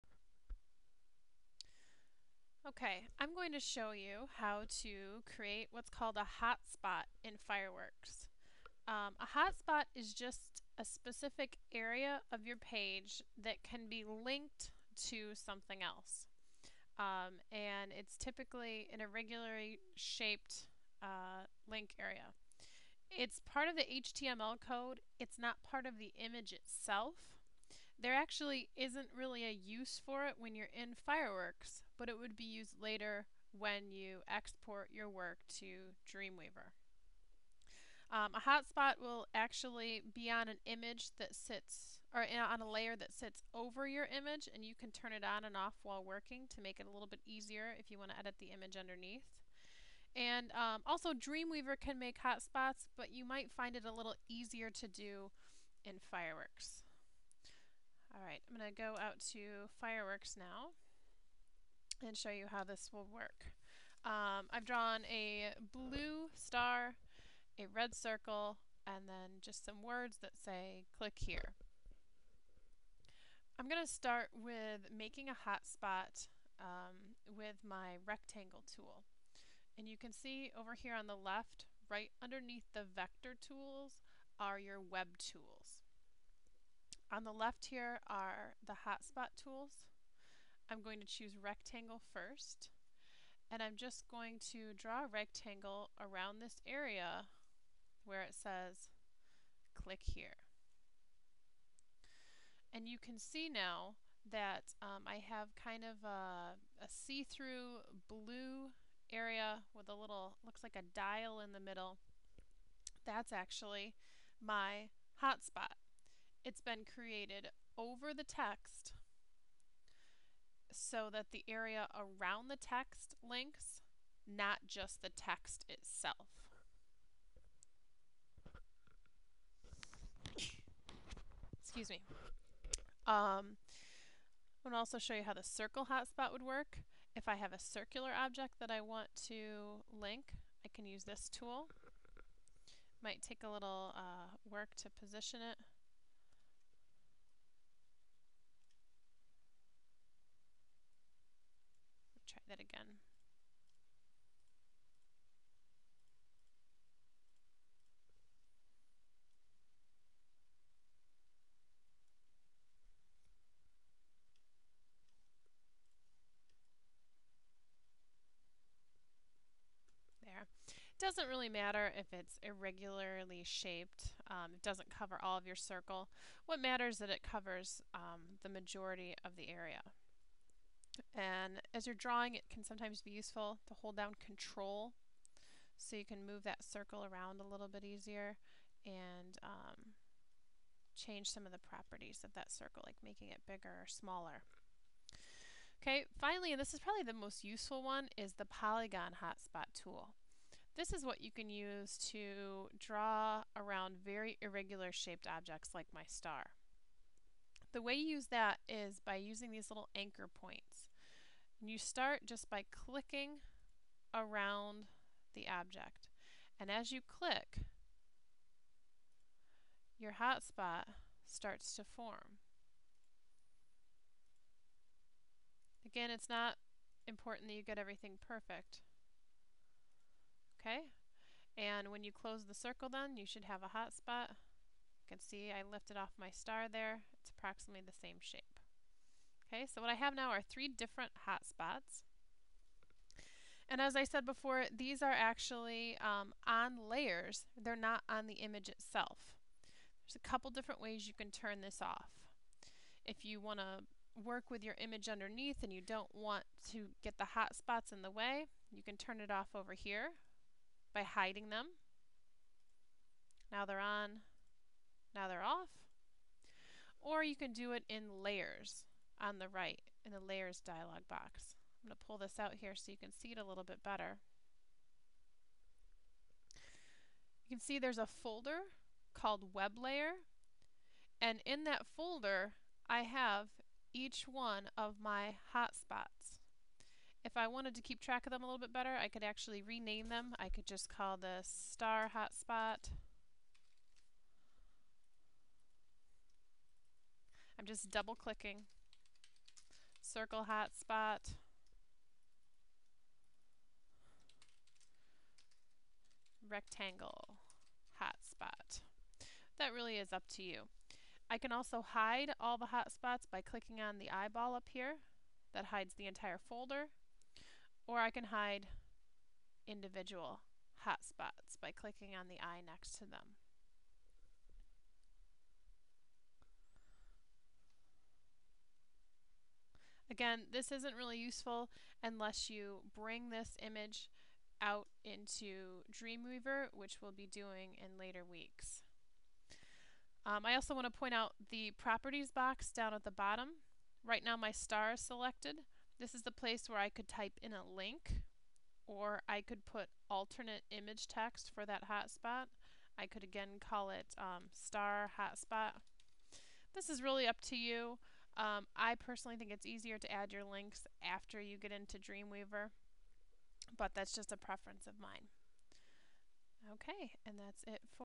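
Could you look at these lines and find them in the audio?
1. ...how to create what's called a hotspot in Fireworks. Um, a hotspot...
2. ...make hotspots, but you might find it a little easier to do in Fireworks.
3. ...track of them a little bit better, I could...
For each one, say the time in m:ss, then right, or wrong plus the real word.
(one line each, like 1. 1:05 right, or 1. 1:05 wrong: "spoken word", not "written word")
1. 0:04 right
2. 0:51 right
3. 4:47 right.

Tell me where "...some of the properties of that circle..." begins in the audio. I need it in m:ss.
3:11.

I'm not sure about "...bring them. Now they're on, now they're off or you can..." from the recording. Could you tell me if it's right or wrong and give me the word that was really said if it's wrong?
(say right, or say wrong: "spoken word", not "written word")
wrong: "hiding", not "bring".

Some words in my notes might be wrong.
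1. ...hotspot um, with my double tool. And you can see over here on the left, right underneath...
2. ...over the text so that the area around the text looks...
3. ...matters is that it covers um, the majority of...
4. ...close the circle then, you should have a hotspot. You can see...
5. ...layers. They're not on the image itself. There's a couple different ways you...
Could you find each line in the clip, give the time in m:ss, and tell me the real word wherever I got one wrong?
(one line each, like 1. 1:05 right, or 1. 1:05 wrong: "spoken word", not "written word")
1. 1:15 wrong: "rectangle", not "double"
2. 1:57 wrong: "links", not "looks"
3. 2:56 right
4. 3:52 right
5. 4:06 right.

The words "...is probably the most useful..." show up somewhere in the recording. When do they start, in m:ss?
3:16.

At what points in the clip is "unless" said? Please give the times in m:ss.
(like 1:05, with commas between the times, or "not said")
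5:32.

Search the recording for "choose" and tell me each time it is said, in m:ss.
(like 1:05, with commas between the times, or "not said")
1:31.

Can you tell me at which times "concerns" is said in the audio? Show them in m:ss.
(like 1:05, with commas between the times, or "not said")
not said.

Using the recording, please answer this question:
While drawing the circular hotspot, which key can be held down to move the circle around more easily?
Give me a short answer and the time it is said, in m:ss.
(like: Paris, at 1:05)
control, at 3:04.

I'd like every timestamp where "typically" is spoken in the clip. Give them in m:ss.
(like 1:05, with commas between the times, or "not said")
0:18.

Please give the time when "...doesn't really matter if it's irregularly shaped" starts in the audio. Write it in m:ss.
2:50.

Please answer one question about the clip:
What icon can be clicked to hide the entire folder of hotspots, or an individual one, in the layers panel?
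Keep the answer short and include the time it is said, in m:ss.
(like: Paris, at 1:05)
eyeball, at 5:14.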